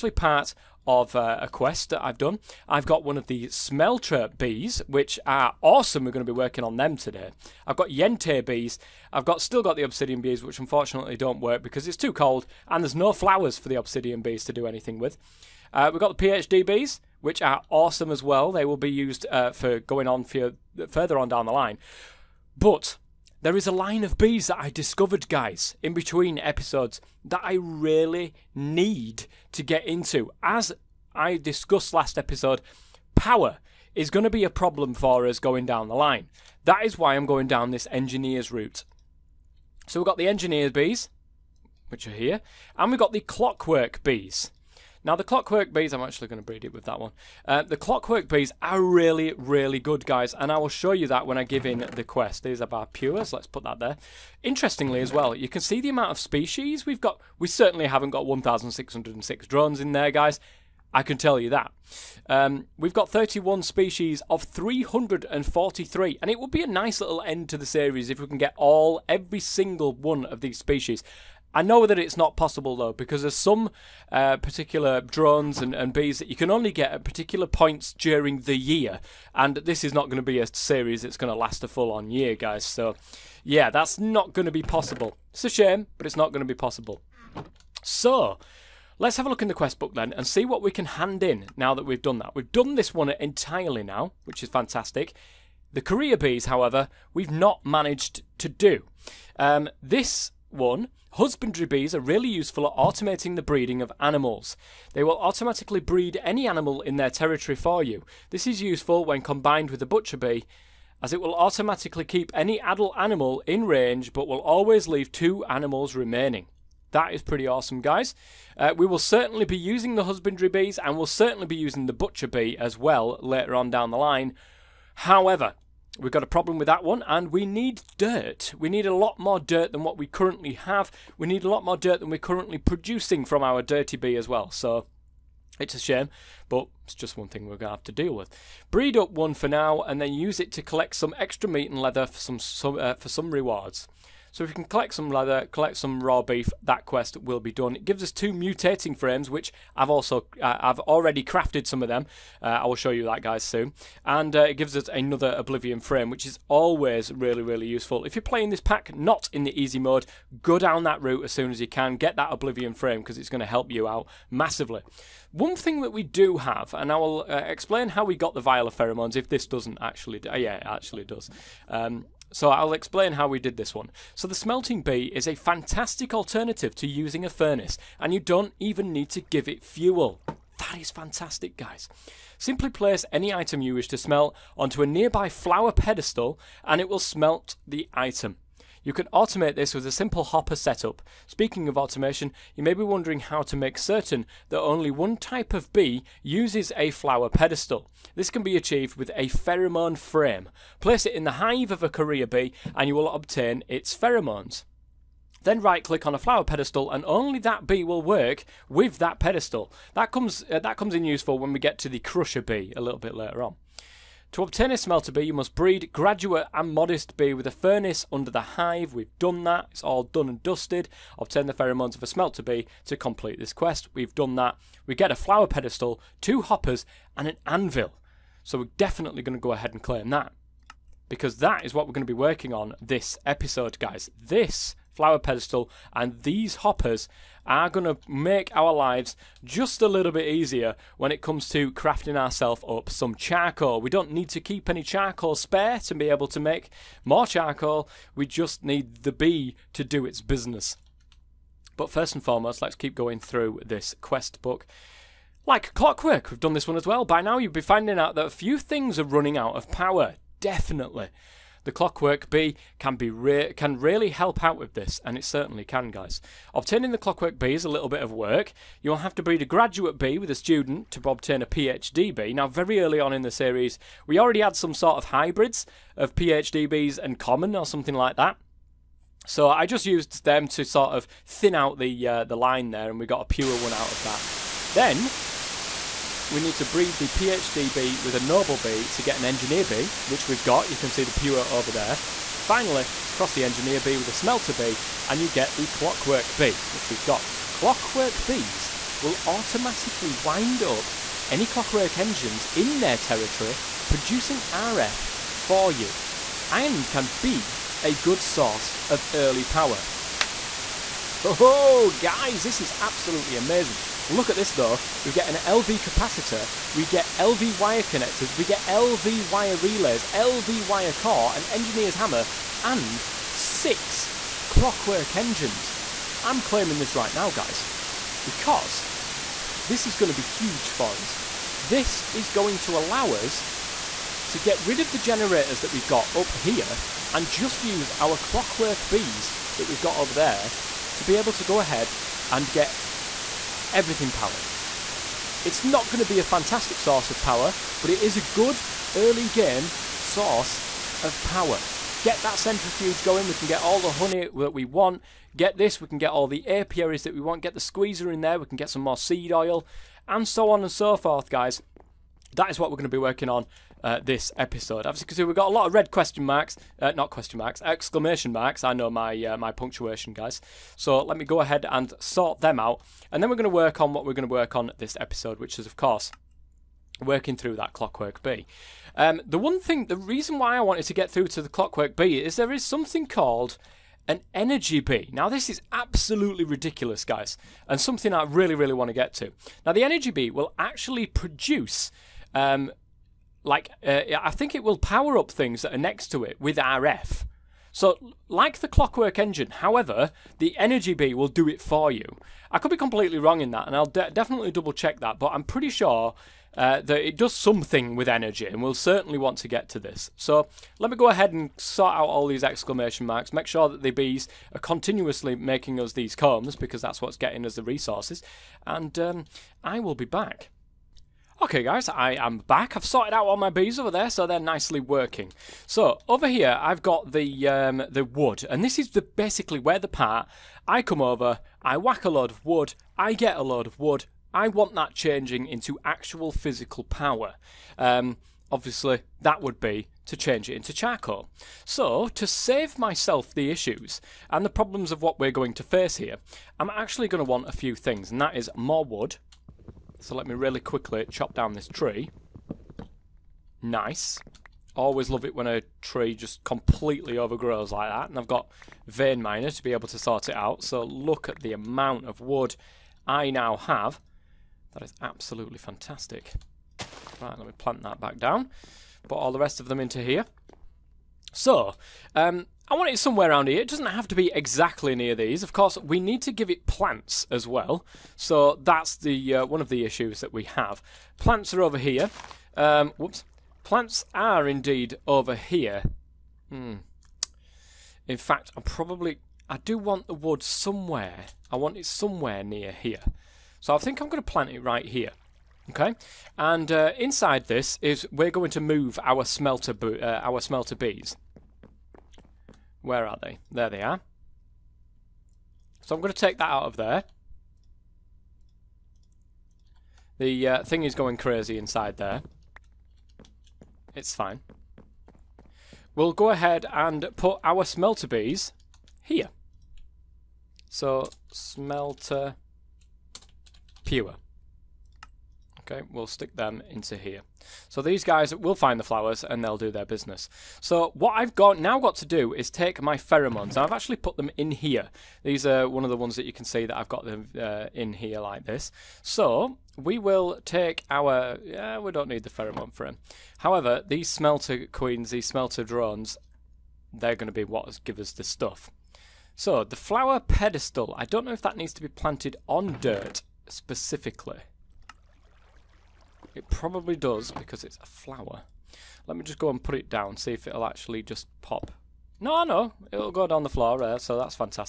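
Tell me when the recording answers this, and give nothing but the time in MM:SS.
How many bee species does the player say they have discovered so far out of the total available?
01:03.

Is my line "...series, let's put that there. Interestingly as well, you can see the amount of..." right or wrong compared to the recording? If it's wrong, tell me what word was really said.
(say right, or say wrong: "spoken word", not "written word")
wrong: "pures", not "series".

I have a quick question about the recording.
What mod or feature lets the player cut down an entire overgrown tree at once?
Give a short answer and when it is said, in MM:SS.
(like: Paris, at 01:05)
Vein miner, at 07:38.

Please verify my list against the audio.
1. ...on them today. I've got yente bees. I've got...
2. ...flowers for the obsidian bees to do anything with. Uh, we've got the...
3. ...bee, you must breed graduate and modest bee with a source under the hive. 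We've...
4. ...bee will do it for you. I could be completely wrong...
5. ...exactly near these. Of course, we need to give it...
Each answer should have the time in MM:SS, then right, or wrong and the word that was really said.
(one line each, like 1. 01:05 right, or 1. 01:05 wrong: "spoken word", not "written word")
1. 00:06 right
2. 00:13 right
3. 03:35 wrong: "furnace", not "source"
4. 06:40 right
5. 07:54 right.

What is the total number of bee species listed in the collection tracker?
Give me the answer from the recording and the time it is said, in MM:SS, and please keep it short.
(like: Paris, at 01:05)
343, at 01:04.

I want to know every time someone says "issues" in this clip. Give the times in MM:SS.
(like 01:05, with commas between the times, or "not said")
07:23, 07:59.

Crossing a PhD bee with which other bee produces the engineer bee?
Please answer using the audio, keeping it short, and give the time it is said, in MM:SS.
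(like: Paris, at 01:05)
Noble bee, at 04:48.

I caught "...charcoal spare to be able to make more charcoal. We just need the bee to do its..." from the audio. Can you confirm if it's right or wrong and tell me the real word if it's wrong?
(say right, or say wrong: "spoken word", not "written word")
right.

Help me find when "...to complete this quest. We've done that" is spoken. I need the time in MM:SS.
03:42.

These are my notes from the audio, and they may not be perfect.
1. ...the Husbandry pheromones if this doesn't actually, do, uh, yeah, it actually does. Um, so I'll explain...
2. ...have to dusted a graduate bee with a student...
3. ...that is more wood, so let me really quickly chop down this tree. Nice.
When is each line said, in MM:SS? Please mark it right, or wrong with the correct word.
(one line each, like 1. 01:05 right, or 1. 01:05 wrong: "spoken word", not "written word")
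1. 02:48 wrong: "Viola", not "Husbandry"
2. 04:28 wrong: "breed", not "dusted"
3. 07:28 right.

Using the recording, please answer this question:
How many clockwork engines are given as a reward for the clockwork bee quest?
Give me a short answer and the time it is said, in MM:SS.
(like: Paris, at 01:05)
6, at 05:23.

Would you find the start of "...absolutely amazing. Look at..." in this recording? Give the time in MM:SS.
05:12.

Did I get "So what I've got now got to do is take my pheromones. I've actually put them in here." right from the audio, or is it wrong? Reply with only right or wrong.
right.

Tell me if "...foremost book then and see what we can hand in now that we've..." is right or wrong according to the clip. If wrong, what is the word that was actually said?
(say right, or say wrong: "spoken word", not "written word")
wrong: "quest", not "foremost".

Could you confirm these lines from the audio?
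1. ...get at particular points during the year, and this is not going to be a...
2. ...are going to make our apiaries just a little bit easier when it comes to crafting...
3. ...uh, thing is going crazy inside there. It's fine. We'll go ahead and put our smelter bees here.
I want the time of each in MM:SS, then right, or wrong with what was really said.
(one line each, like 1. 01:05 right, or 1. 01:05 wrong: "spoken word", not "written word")
1. 01:16 right
2. 03:57 wrong: "lives", not "apiaries"
3. 08:30 right.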